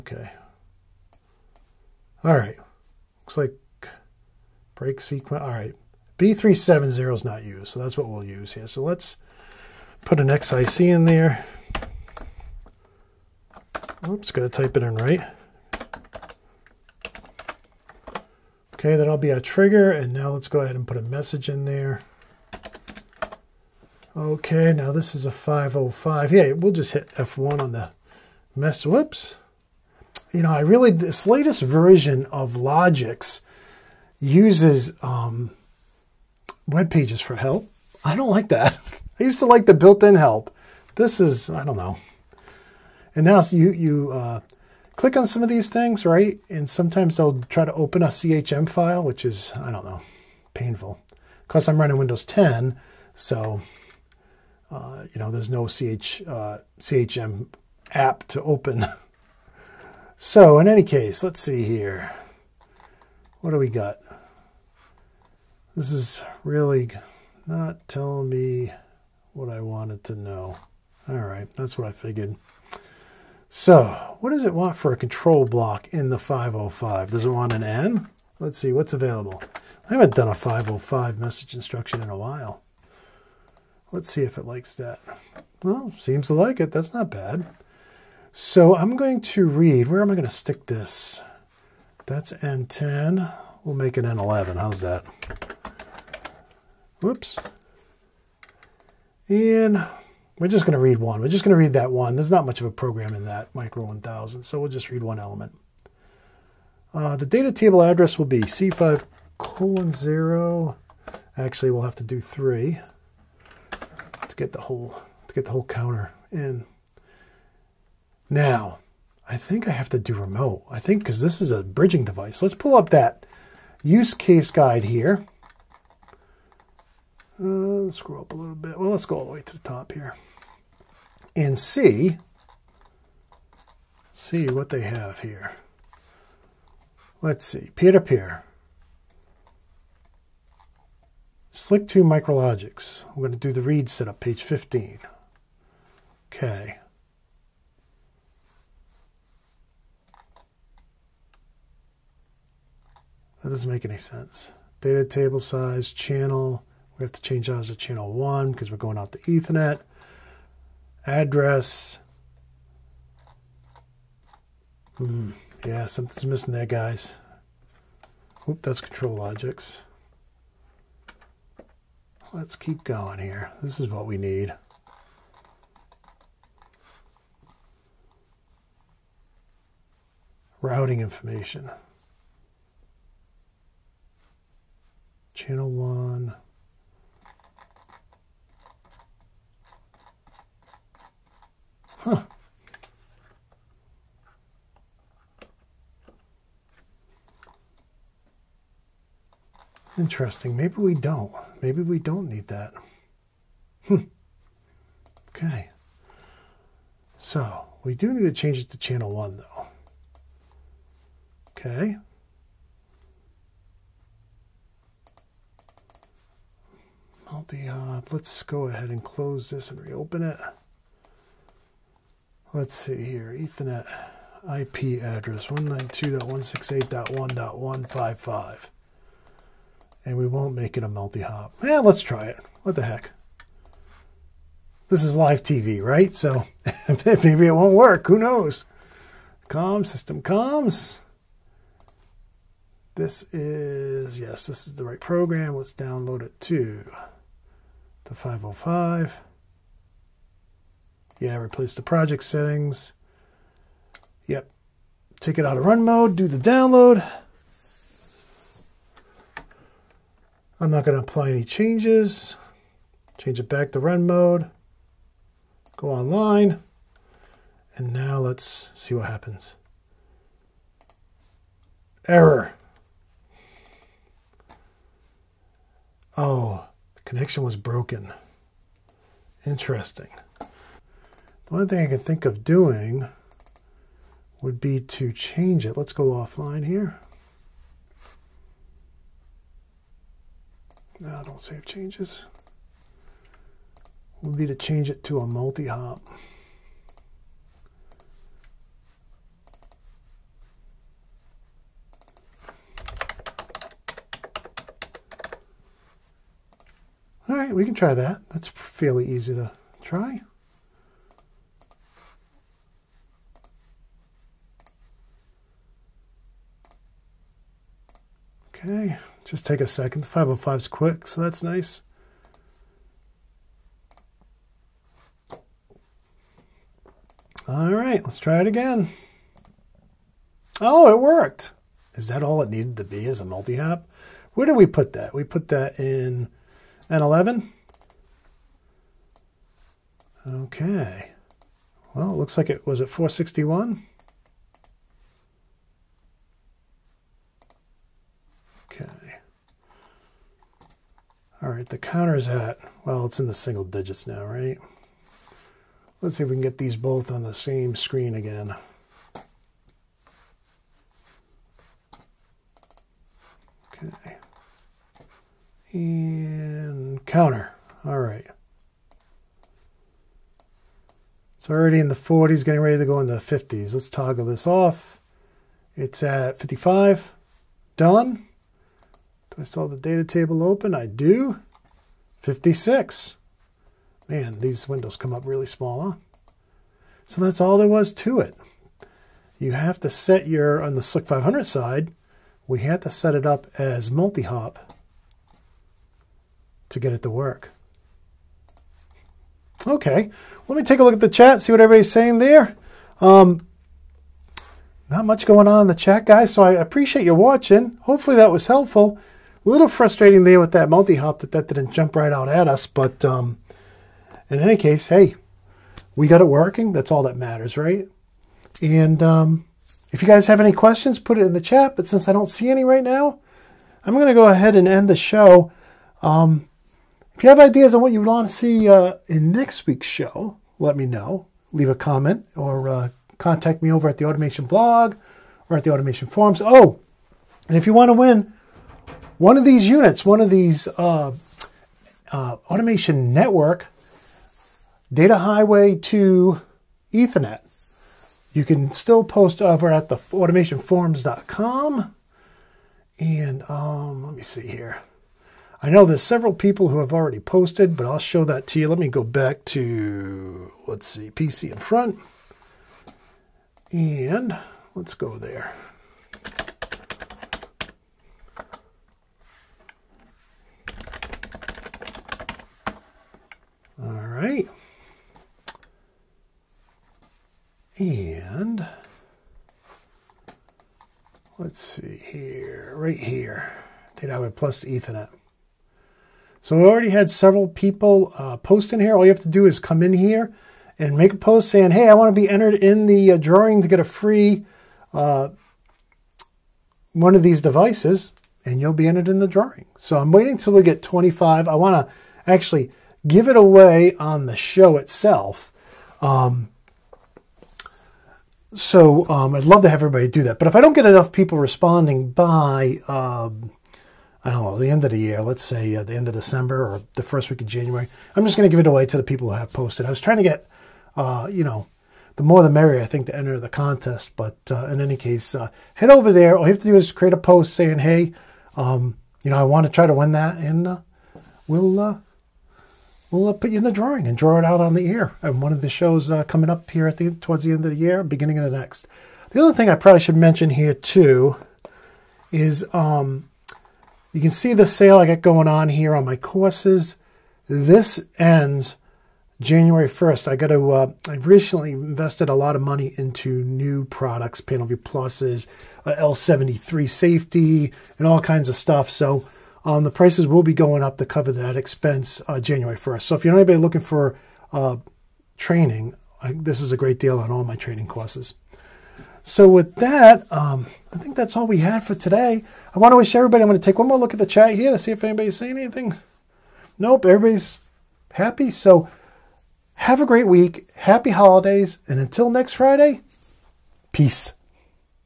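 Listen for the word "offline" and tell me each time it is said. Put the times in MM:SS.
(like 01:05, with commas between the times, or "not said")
04:46.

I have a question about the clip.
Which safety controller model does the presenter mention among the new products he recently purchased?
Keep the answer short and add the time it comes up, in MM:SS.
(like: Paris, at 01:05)
L73, at 09:15.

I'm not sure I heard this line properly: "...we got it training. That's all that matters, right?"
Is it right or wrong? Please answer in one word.
wrong.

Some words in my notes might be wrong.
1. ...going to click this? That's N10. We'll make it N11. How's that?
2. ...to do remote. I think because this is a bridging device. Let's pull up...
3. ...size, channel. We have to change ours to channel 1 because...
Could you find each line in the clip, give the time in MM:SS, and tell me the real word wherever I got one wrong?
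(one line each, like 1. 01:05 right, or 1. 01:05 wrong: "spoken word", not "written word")
1. 01:30 wrong: "stick", not "click"
2. 01:59 right
3. 02:35 right.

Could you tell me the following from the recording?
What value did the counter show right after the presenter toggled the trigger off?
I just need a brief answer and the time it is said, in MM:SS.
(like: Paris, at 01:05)
55, at 06:16.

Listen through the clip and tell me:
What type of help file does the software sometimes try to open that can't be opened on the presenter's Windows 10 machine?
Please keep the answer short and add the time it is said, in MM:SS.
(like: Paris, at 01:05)
CHM file, at 00:48.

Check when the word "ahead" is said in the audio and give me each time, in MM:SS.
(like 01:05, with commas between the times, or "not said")
00:20, 03:38, 07:04.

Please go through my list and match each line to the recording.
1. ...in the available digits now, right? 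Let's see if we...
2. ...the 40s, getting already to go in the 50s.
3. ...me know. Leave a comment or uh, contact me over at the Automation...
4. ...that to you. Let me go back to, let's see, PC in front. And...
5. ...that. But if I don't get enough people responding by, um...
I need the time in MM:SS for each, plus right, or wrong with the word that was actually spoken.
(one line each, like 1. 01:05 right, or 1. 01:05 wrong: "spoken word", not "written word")
1. 05:53 wrong: "single", not "available"
2. 06:11 wrong: "ready", not "already"
3. 07:10 right
4. 07:38 right
5. 08:30 right.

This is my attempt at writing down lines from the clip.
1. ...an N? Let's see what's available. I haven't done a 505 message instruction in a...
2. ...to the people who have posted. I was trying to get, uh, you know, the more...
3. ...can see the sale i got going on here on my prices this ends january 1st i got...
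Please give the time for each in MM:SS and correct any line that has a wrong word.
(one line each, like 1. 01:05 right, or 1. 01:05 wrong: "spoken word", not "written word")
1. 01:17 right
2. 08:38 right
3. 09:04 wrong: "courses", not "prices".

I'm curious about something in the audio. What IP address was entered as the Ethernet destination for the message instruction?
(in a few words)
192.168.1.155.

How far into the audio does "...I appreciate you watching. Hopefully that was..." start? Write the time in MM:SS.
06:46.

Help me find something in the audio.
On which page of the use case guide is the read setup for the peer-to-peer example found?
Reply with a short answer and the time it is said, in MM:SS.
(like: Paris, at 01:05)
Page 15, at 02:24.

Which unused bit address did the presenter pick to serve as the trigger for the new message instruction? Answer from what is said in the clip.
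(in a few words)
B3:70.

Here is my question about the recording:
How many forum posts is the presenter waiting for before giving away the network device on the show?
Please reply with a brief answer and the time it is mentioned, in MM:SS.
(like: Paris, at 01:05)
25, at 08:20.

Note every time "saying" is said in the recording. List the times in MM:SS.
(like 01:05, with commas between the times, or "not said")
06:41, 08:11, 08:47, 09:35.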